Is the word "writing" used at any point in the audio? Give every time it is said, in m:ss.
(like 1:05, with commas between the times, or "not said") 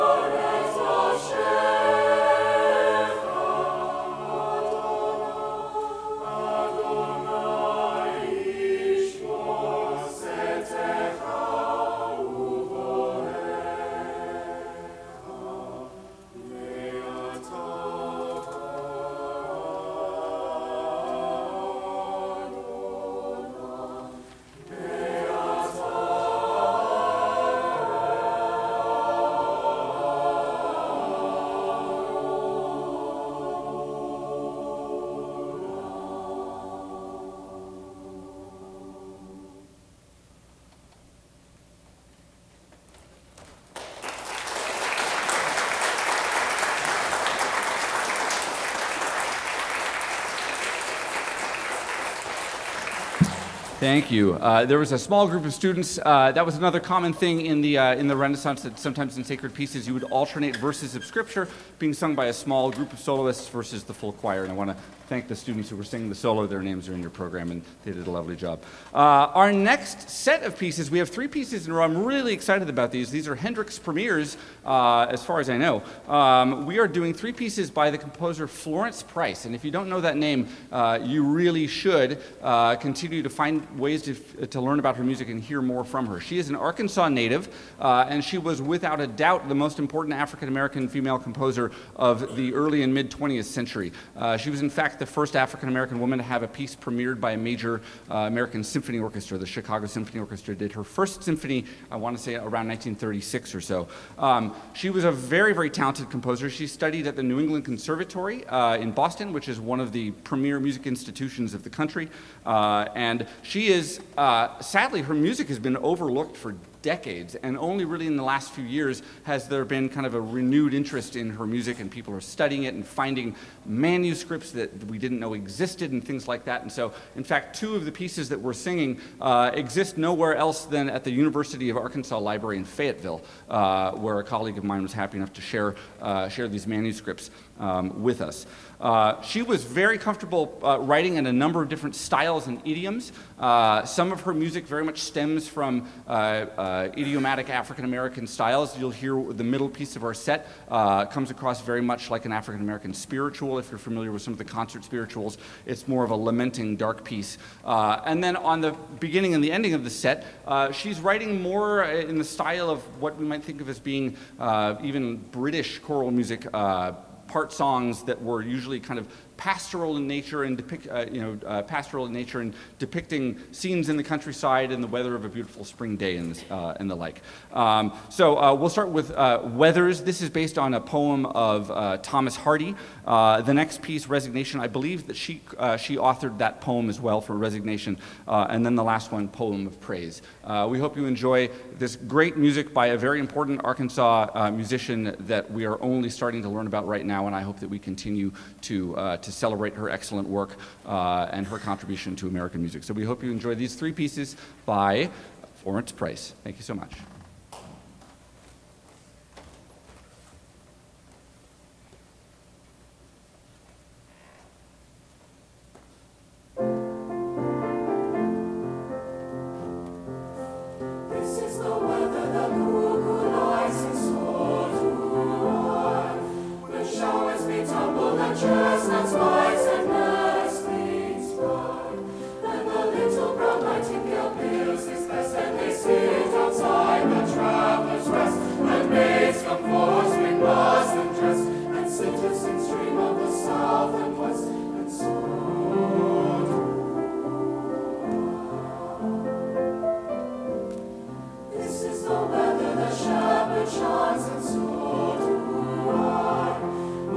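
2:20, 2:41.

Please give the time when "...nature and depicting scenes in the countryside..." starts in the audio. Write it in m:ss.
2:52.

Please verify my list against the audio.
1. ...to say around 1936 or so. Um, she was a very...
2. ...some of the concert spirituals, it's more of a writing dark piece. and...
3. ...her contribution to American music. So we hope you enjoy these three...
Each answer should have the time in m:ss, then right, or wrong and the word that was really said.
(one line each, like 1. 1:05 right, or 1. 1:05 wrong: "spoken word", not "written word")
1. 1:42 right
2. 2:34 wrong: "lamenting", not "writing"
3. 3:21 right.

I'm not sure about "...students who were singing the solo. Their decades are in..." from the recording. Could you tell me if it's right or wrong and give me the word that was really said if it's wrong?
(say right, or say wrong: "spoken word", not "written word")
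wrong: "names", not "decades".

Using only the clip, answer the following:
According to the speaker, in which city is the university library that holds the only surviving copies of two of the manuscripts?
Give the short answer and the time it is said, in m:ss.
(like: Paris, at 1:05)
Fayetteville, at 2:12.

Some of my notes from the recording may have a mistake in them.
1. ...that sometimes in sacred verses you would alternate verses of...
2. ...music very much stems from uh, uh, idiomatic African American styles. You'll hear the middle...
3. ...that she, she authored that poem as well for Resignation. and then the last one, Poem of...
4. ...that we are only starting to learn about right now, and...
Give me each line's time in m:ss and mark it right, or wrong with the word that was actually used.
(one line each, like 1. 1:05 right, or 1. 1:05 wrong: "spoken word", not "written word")
1. 0:58 wrong: "pieces", not "verses"
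2. 2:24 right
3. 3:05 right
4. 3:15 right.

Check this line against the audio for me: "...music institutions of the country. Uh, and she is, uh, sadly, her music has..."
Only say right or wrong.
right.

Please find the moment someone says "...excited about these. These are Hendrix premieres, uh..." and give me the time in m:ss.
1:12.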